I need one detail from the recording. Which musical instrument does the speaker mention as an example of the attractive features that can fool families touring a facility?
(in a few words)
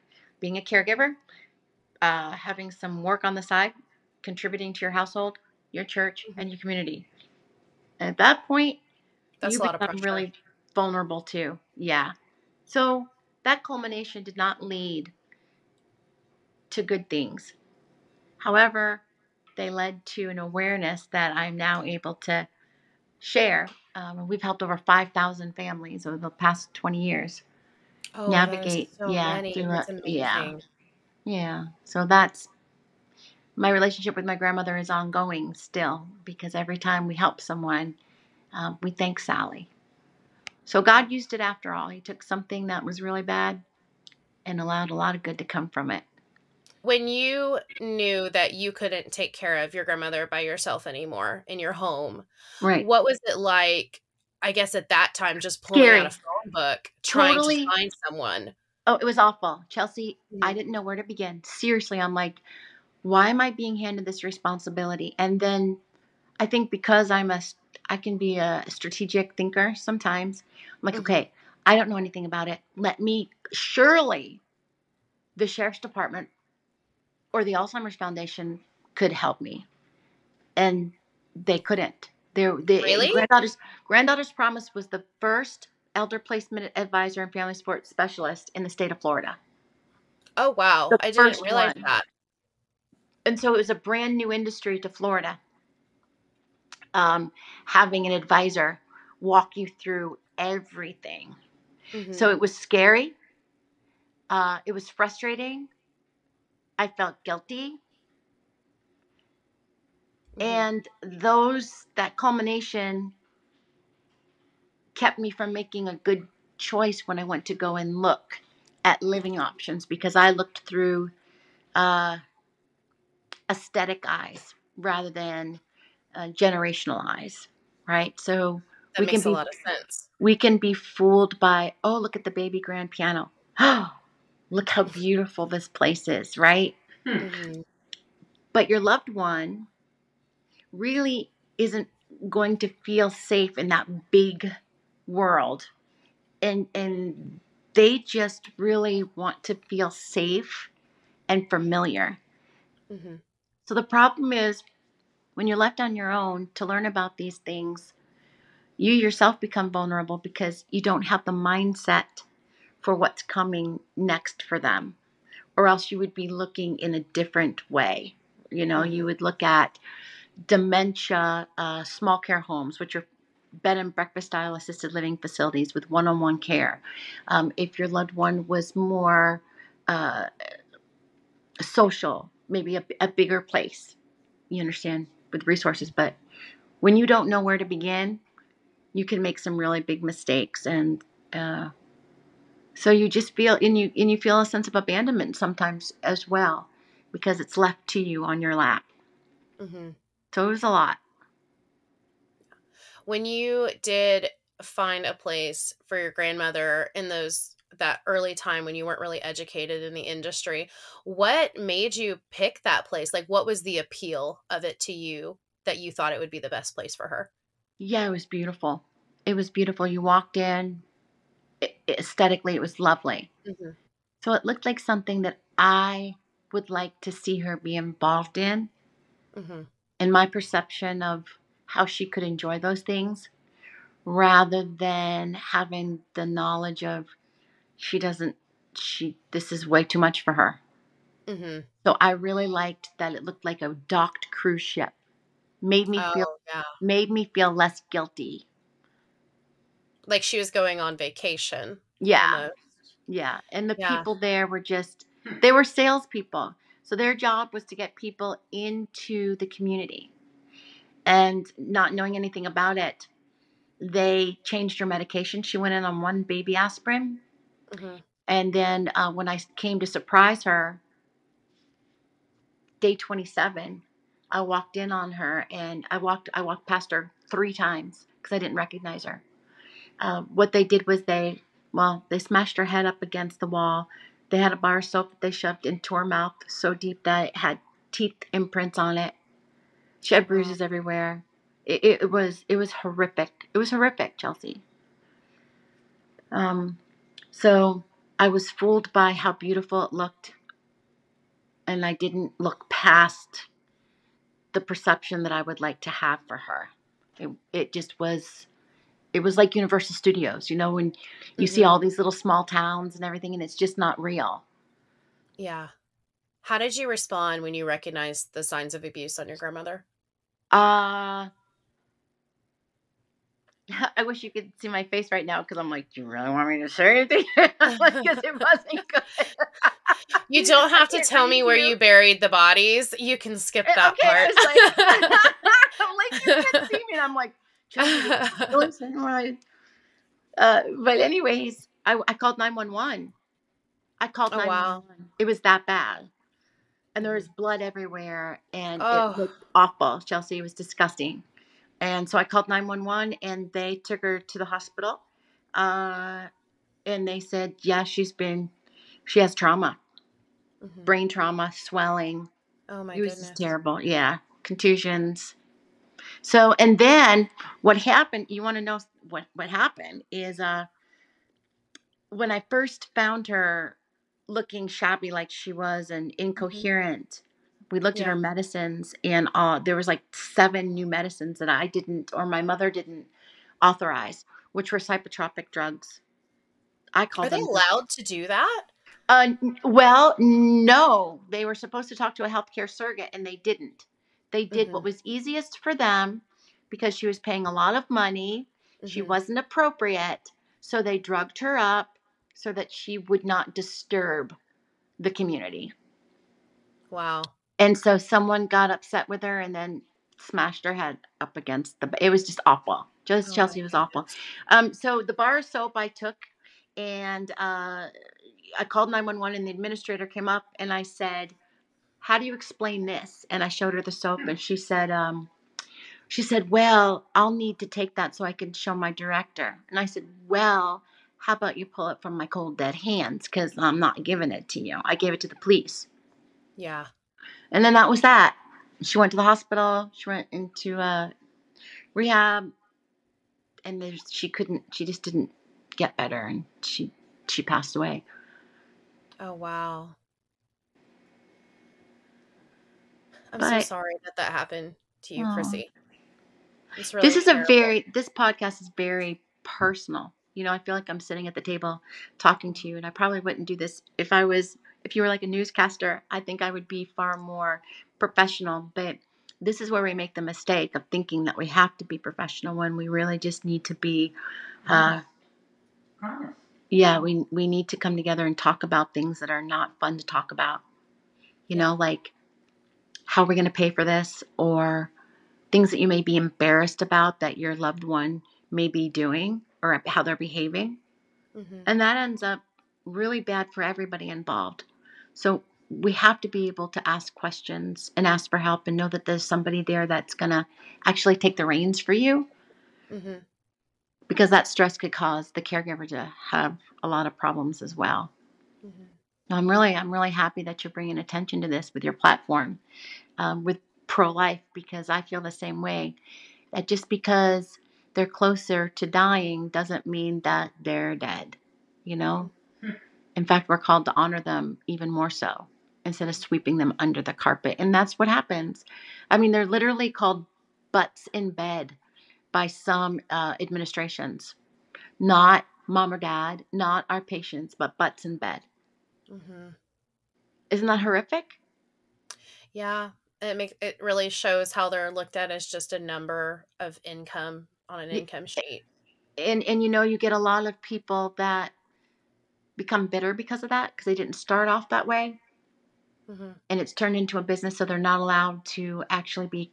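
Baby grand piano.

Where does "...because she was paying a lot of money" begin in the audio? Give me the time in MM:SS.
06:36.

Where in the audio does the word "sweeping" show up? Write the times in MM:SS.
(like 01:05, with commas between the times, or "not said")
08:46.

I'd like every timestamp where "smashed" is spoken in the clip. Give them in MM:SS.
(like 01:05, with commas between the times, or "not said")
04:42, 06:50.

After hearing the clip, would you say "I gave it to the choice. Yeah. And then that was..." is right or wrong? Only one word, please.
wrong.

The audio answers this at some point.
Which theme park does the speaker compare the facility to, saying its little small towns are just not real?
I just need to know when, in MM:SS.
05:09.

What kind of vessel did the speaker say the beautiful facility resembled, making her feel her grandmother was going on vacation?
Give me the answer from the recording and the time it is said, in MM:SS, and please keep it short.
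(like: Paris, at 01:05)
Docked cruise ship, at 04:03.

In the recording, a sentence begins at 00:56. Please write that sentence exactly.
out a phone book, trying totally.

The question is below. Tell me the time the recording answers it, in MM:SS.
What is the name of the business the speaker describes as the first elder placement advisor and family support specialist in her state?
01:23.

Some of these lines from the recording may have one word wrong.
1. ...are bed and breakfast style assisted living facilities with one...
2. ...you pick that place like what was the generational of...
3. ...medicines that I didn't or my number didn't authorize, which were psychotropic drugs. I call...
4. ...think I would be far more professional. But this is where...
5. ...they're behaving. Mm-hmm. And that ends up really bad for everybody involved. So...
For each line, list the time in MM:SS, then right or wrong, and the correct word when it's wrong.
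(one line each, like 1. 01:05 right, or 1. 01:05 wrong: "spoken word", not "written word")
1. 02:52 right
2. 03:31 wrong: "appeal", not "generational"
3. 06:20 wrong: "mother", not "number"
4. 07:46 right
5. 08:10 right.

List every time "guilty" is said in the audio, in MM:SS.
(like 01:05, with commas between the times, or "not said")
01:47, 04:07.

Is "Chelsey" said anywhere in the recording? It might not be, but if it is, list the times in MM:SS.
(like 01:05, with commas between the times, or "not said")
00:59, 04:54, 05:50, 06:53.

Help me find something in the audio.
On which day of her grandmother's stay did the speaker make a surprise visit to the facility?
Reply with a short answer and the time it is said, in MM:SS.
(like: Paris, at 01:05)
Day 27, at 04:32.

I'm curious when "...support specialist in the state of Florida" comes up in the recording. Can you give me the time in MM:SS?
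01:27.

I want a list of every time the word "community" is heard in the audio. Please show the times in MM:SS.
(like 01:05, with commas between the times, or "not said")
00:06, 04:19, 06:45.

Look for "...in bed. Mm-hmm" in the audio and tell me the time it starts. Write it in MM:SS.
08:58.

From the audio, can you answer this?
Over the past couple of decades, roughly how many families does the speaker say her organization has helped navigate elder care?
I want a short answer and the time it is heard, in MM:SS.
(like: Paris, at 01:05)
5,000, at 00:24.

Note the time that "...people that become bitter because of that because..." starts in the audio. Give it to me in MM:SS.
09:10.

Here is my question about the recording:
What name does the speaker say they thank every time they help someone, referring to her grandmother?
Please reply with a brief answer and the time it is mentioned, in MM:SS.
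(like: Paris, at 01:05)
Sally, at 00:39.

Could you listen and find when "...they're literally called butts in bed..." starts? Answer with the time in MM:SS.
08:49.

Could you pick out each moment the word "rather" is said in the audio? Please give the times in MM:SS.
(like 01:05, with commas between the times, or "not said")
02:04, 03:54.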